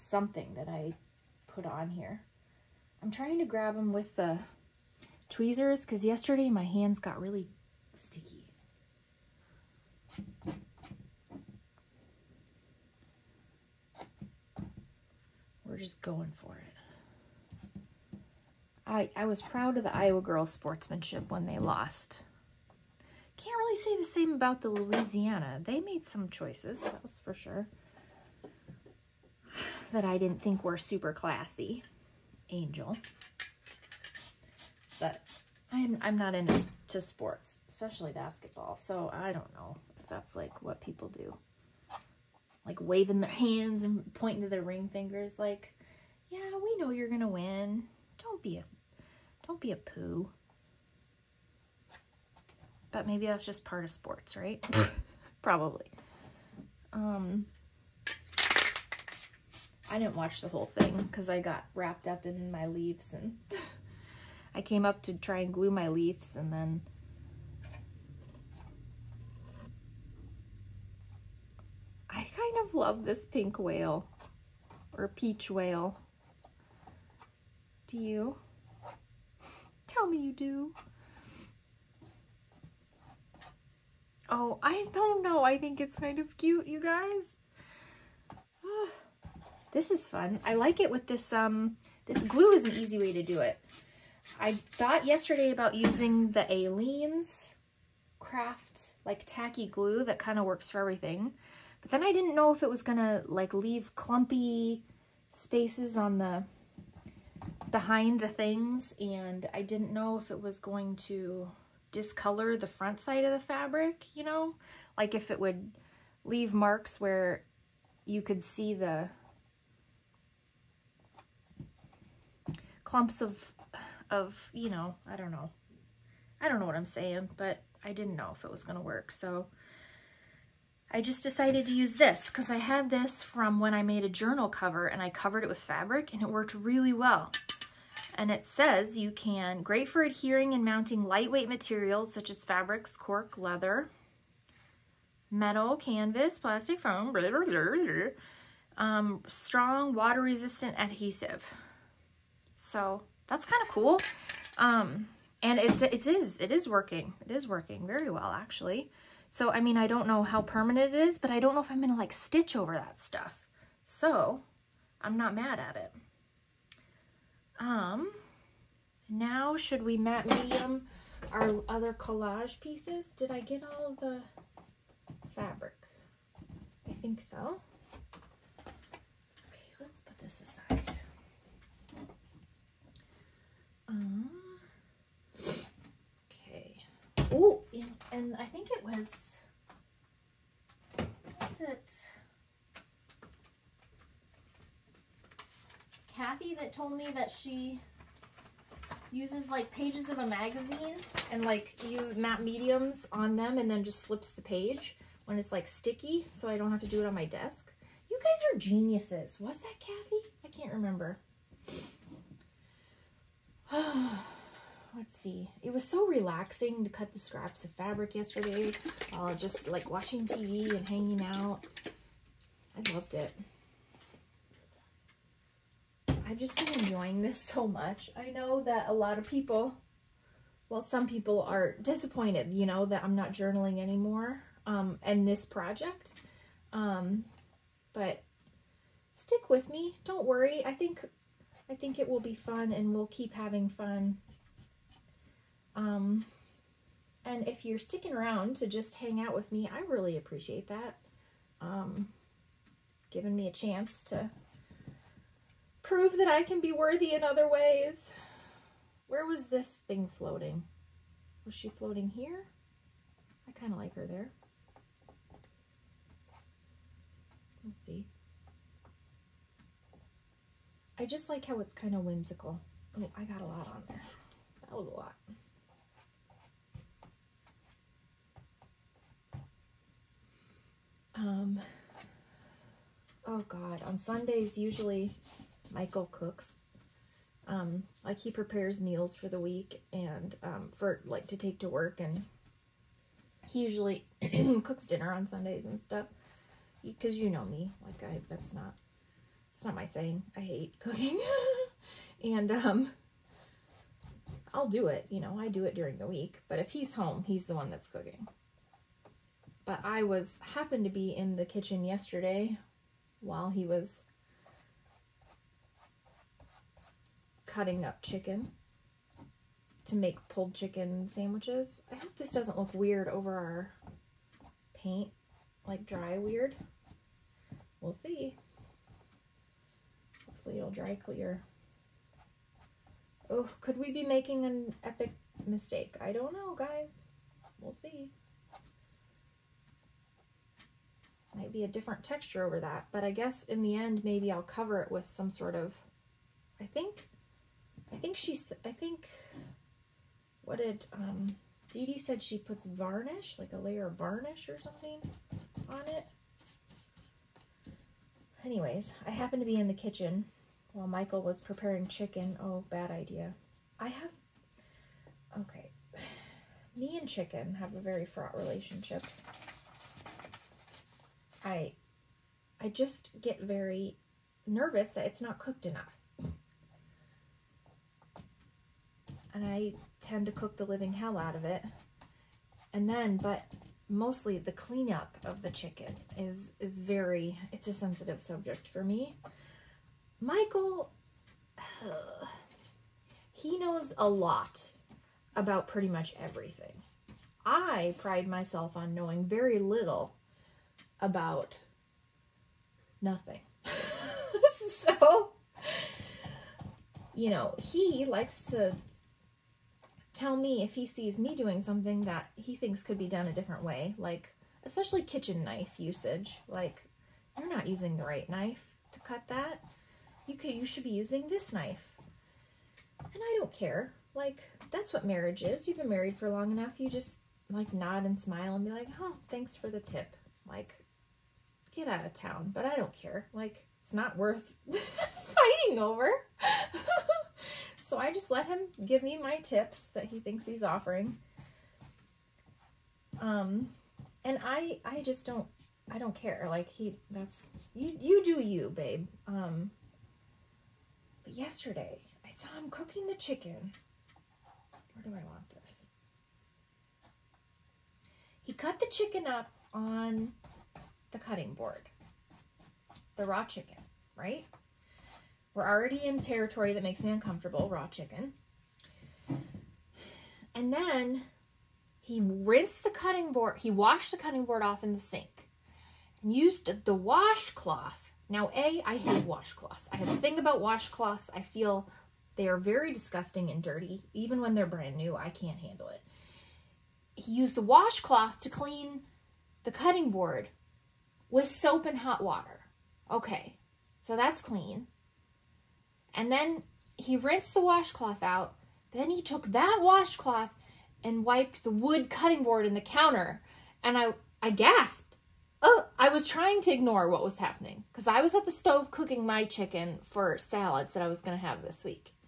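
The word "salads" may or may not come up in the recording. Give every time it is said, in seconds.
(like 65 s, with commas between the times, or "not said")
510 s.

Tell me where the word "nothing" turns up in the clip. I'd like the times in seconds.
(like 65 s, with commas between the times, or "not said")
403 s.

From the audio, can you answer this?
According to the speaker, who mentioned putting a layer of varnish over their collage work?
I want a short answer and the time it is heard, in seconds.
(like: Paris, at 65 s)
Dee Dee, at 351 s.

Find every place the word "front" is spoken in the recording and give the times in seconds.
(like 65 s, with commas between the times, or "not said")
112 s.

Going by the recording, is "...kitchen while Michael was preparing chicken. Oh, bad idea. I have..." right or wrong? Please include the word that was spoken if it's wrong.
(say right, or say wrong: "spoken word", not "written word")
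right.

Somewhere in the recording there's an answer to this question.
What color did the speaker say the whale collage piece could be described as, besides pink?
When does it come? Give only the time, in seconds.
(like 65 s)
75 s.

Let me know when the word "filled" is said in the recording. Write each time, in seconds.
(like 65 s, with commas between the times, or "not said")
not said.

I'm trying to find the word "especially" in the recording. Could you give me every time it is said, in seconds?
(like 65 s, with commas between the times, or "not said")
37 s, 414 s.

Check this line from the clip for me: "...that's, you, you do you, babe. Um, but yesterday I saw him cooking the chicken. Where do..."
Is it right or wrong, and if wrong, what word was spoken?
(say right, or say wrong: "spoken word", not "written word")
right.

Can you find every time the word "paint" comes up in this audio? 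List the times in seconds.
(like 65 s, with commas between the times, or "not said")
324 s.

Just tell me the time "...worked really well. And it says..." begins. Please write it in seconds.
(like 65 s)
136 s.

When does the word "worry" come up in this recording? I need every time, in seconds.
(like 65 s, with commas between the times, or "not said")
240 s.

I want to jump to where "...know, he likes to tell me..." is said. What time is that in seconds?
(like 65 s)
407 s.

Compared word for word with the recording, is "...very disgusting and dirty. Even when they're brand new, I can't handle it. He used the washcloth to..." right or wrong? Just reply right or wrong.
right.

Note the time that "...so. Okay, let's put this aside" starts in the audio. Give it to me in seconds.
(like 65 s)
177 s.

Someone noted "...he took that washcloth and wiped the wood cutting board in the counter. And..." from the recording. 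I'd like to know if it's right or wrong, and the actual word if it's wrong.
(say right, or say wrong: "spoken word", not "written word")
right.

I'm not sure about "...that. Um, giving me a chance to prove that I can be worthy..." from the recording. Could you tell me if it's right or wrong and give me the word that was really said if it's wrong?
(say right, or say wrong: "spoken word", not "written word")
right.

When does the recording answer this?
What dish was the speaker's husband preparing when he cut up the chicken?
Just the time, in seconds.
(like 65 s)
320 s.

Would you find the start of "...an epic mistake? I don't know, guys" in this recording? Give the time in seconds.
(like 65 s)
334 s.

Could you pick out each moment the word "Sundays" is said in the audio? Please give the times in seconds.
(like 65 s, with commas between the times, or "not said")
283 s, 295 s.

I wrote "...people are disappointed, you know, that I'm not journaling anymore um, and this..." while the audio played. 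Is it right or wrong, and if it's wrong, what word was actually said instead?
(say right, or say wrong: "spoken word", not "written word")
right.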